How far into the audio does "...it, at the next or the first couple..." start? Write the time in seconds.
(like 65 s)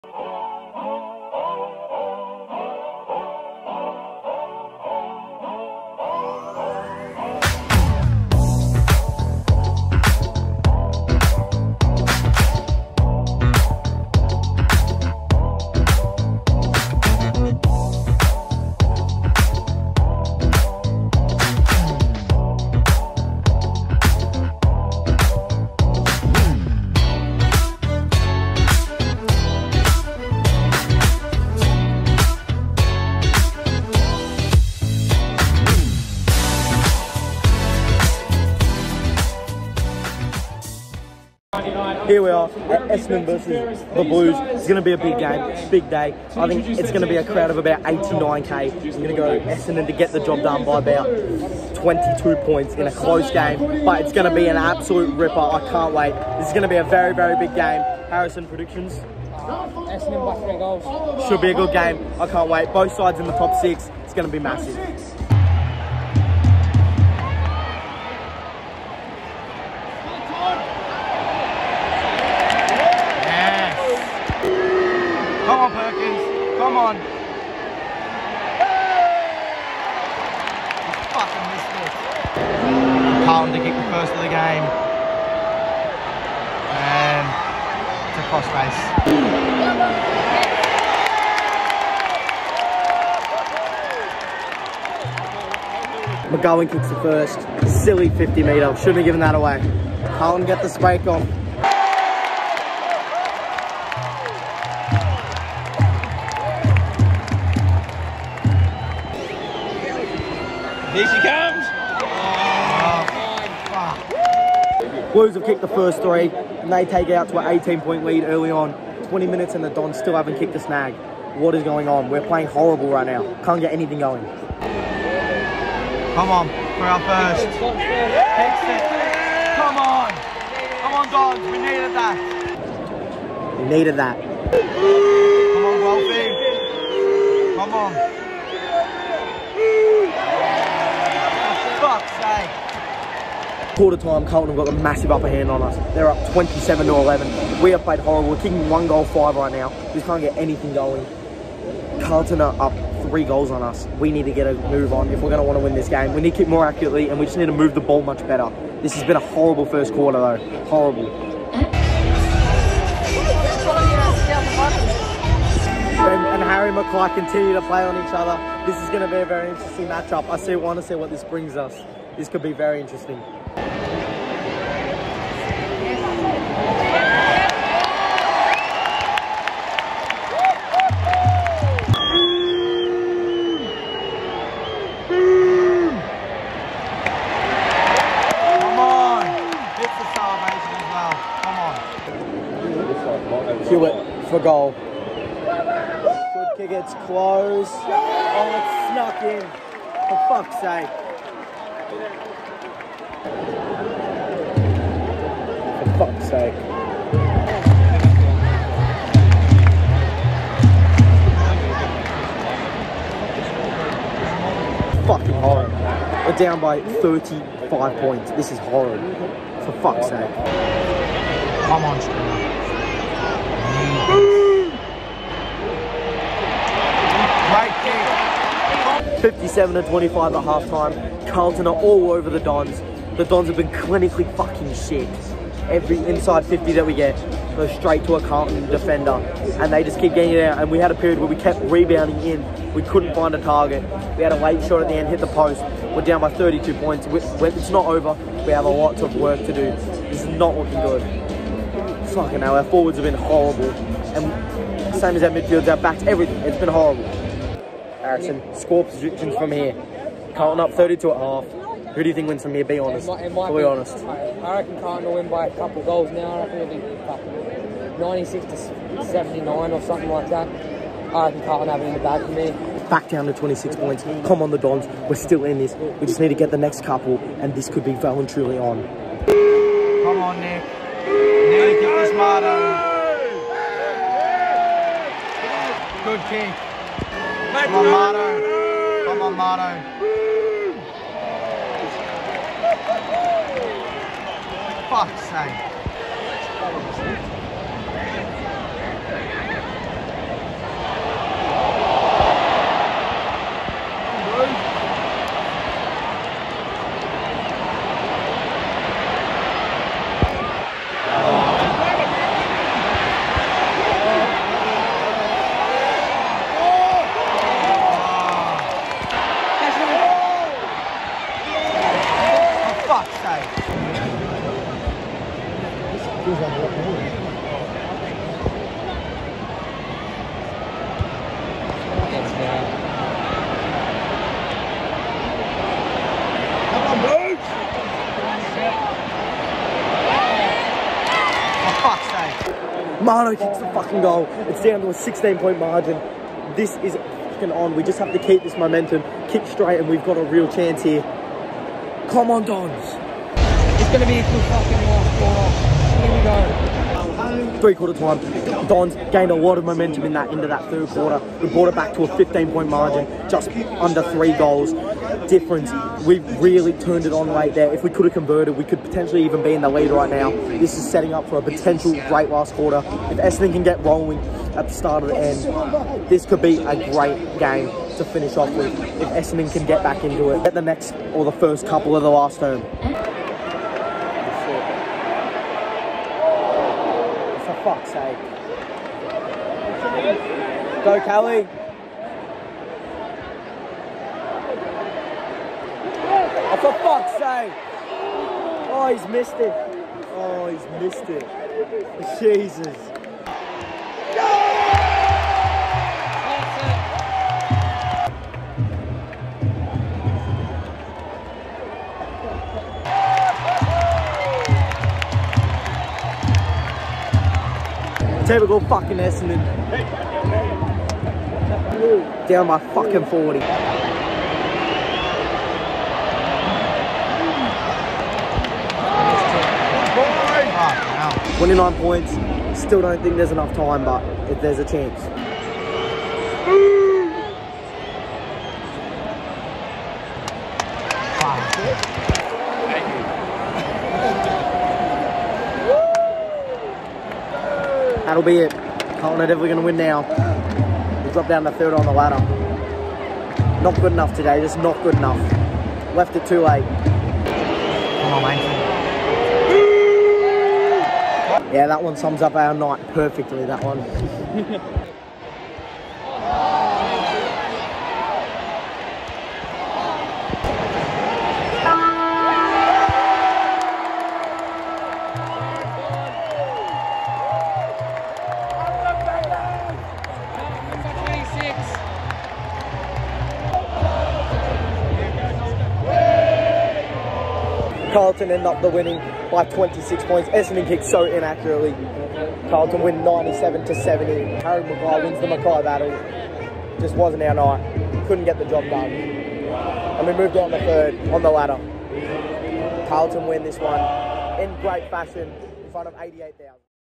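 380 s.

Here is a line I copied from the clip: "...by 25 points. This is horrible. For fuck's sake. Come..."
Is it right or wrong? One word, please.
wrong.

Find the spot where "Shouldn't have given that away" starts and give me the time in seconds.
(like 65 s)
98 s.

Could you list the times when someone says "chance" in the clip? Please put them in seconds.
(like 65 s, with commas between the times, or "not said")
350 s, 434 s.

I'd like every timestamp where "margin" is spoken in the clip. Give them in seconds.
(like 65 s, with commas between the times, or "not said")
345 s, 362 s.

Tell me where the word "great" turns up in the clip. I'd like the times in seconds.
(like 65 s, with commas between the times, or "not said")
372 s, 376 s, 504 s.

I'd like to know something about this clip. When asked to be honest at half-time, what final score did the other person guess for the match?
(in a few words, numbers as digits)
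96 to 79.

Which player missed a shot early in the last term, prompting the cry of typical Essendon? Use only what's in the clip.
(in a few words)
Kelly.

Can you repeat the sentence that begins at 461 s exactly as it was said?
Yeah, that one sums up our night perfectly, that one.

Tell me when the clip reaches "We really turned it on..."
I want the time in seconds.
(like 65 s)
366 s.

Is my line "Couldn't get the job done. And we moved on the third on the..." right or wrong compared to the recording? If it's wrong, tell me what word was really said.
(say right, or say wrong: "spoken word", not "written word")
right.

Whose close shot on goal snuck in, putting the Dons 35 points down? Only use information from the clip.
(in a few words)
Hewitt.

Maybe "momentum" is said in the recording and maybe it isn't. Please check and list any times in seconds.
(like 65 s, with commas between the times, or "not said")
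348 s, 359 s.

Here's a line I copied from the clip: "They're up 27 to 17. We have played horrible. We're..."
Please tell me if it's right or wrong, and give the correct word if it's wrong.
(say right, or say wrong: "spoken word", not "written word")
wrong: "11", not "17".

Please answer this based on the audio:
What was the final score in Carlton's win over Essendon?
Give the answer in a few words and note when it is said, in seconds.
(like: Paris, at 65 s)
97 to 70, at 493 s.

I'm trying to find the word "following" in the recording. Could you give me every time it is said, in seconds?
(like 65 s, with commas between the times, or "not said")
not said.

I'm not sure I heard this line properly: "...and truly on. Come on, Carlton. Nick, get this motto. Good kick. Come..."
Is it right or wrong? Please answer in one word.
wrong.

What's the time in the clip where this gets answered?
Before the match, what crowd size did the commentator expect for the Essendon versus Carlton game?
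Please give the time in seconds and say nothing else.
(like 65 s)
47 s.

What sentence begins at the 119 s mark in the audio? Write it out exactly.
20 minutes, and the Dons still haven't kicked a snag.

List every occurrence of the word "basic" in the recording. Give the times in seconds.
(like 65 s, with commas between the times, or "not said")
not said.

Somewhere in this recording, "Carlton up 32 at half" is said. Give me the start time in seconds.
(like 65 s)
260 s.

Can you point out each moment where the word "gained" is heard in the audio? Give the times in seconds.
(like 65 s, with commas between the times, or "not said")
359 s.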